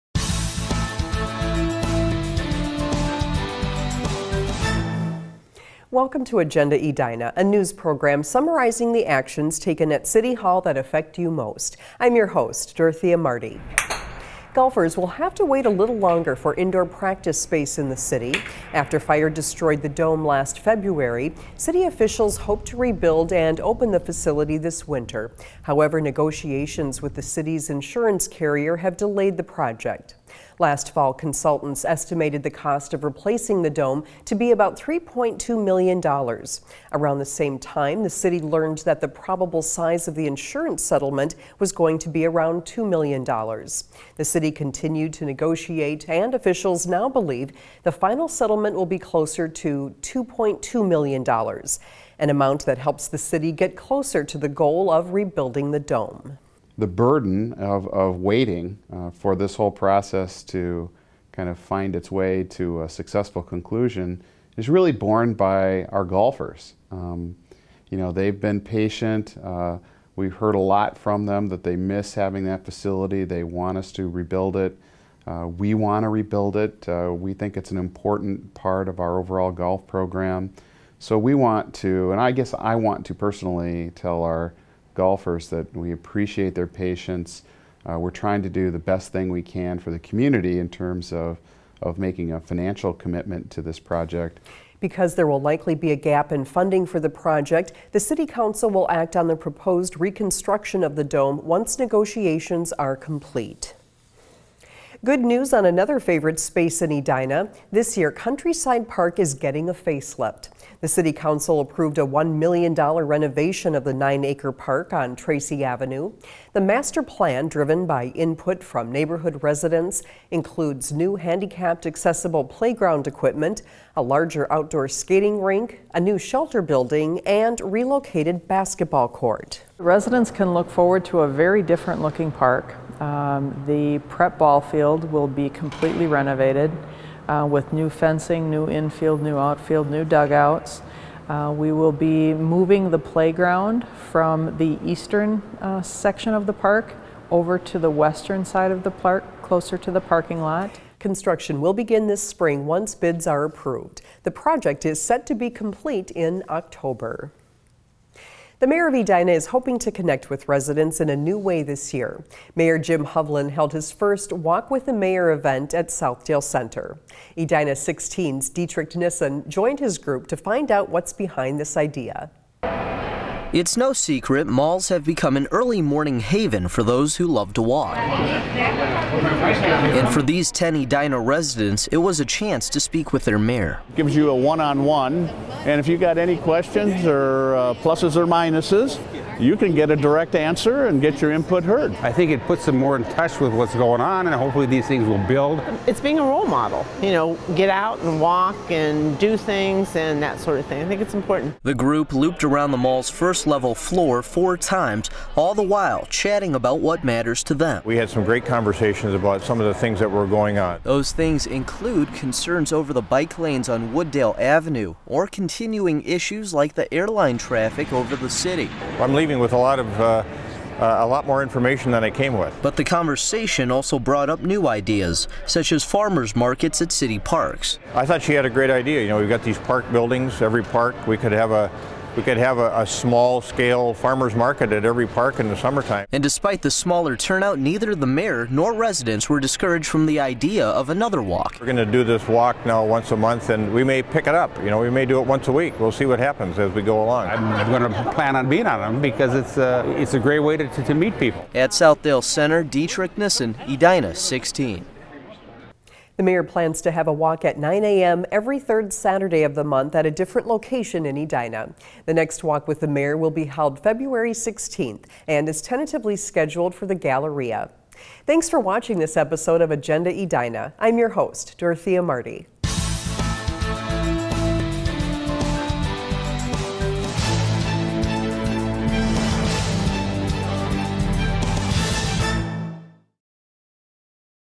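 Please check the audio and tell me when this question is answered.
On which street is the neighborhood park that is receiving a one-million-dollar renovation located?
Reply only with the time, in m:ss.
1:55.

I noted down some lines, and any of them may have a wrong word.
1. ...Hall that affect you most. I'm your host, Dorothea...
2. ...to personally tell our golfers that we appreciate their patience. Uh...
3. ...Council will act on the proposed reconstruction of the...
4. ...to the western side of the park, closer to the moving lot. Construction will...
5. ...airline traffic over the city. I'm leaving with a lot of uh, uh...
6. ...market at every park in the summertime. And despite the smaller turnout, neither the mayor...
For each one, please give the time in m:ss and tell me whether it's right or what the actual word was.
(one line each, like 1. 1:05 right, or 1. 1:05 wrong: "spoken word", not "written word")
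1. 0:10 right
2. 1:23 right
3. 1:38 right
4. 2:27 wrong: "parking", not "moving"
5. 3:36 right
6. 3:54 right.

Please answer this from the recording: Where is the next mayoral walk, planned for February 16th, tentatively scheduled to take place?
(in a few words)
the Galleria.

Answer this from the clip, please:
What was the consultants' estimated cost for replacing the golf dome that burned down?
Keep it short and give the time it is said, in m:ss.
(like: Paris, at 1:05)
$3.2 million, at 0:34.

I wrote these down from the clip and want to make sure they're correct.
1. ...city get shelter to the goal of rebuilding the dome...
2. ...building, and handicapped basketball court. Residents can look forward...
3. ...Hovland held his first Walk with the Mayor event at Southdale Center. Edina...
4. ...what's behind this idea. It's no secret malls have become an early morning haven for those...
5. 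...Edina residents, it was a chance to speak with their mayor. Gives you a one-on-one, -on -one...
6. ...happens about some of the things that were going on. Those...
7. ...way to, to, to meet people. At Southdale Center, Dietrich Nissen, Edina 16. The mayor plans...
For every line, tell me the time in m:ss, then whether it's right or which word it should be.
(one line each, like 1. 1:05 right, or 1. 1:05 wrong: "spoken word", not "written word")
1. 0:53 wrong: "closer", not "shelter"
2. 2:06 wrong: "relocated", not "handicapped"
3. 2:43 right
4. 2:50 right
5. 3:00 right
6. 3:28 wrong: "conversations", not "happens"
7. 4:10 right.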